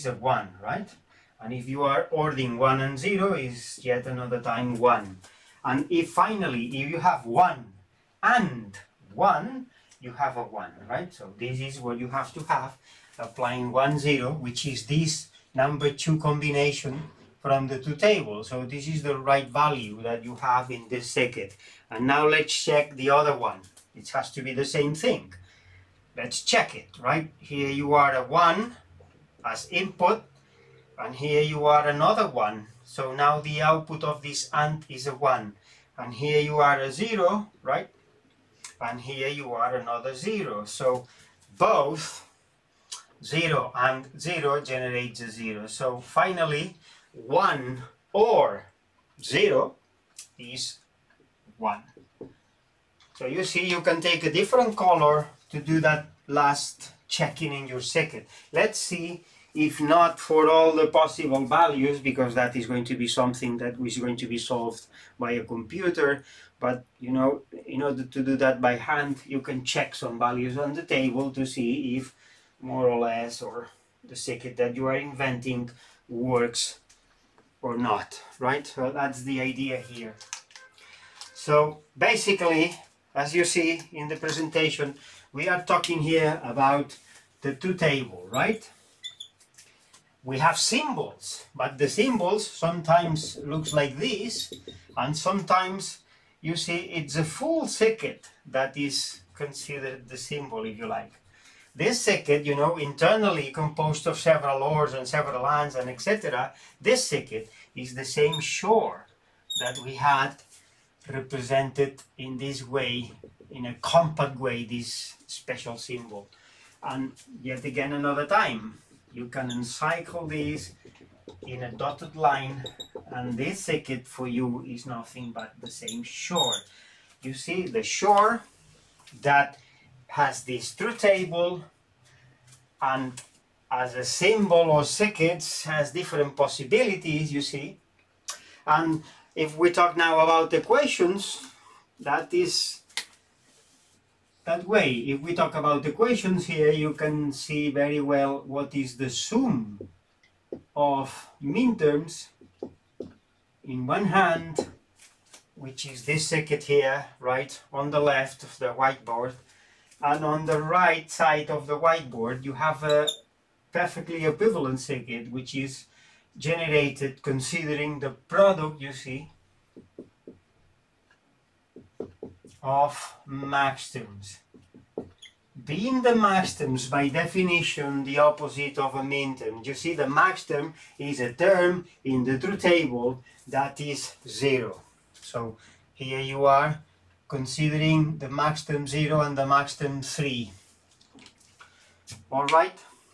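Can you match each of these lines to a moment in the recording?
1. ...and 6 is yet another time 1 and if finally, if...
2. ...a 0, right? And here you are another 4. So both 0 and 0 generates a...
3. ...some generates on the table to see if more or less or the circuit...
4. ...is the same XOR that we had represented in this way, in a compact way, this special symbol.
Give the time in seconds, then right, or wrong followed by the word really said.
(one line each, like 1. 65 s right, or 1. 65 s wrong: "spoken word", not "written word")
1. 2 s wrong: "0", not "6"
2. 36 s wrong: "0", not "4"
3. 69 s wrong: "values", not "generates"
4. 107 s right.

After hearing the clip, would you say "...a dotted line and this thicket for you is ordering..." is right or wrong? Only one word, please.
wrong.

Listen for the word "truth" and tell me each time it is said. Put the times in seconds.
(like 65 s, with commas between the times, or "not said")
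17 s, 87 s, 182 s.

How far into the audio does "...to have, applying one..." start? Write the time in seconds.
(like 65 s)
12 s.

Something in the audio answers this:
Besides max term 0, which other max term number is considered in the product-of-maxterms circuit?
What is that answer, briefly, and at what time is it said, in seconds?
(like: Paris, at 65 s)
3, at 189 s.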